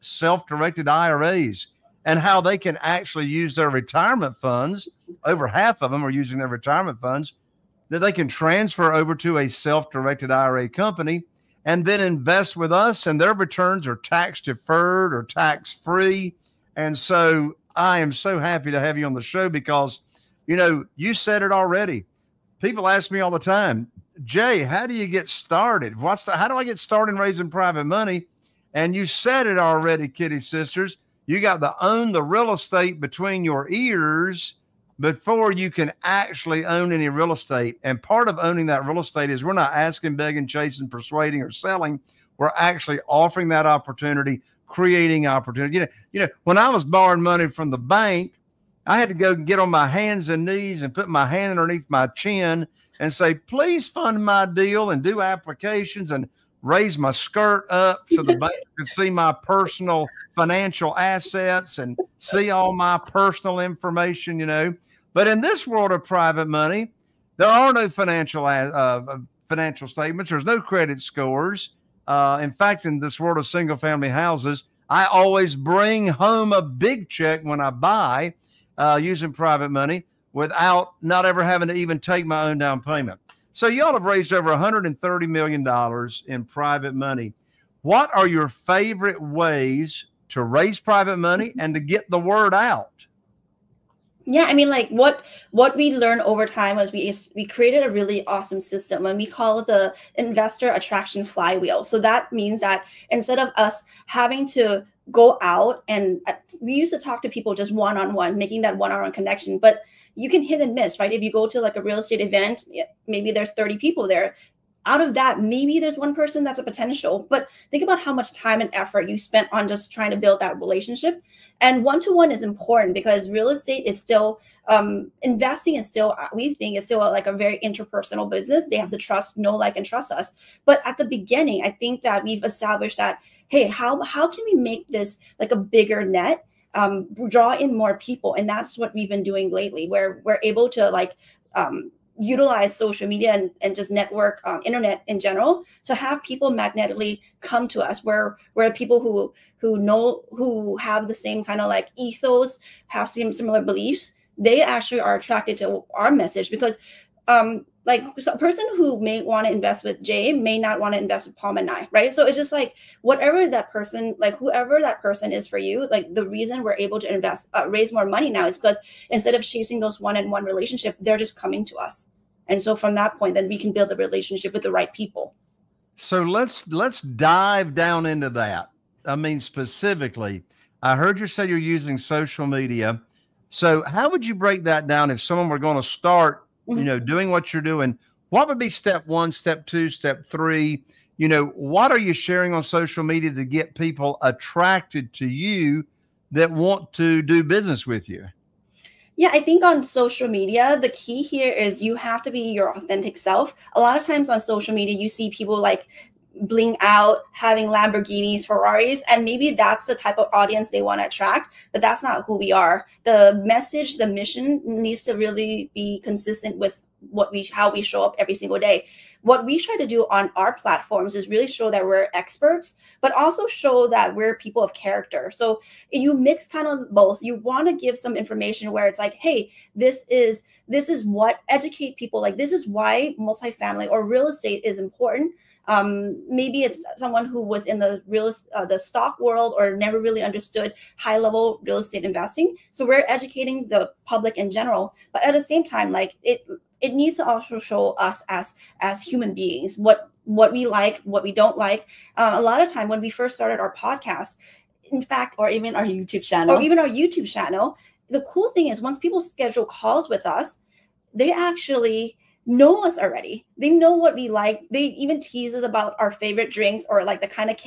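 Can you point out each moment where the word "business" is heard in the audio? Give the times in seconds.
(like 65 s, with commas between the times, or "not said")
128 s, 197 s.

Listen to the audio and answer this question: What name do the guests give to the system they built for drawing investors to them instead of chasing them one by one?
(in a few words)
investor attraction flywheel.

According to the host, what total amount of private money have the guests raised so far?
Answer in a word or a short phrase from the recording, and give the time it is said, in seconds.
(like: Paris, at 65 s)
$130 million, at 84 s.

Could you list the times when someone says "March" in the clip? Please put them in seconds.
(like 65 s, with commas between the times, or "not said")
not said.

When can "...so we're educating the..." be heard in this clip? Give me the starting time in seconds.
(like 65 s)
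242 s.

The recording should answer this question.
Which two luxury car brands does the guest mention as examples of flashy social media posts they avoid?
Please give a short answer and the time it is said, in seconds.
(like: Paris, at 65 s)
Lamborghinis, Ferraris, at 207 s.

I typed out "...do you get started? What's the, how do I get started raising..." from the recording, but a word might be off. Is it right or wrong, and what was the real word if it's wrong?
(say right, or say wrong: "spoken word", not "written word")
right.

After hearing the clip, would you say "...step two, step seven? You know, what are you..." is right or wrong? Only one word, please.
wrong.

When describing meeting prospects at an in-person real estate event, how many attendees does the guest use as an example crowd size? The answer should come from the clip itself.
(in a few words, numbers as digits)
30.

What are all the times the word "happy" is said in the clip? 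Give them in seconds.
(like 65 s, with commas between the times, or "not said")
18 s.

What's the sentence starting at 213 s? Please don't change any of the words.
The message, the mission needs to really be consistent with what we how we show up every single day.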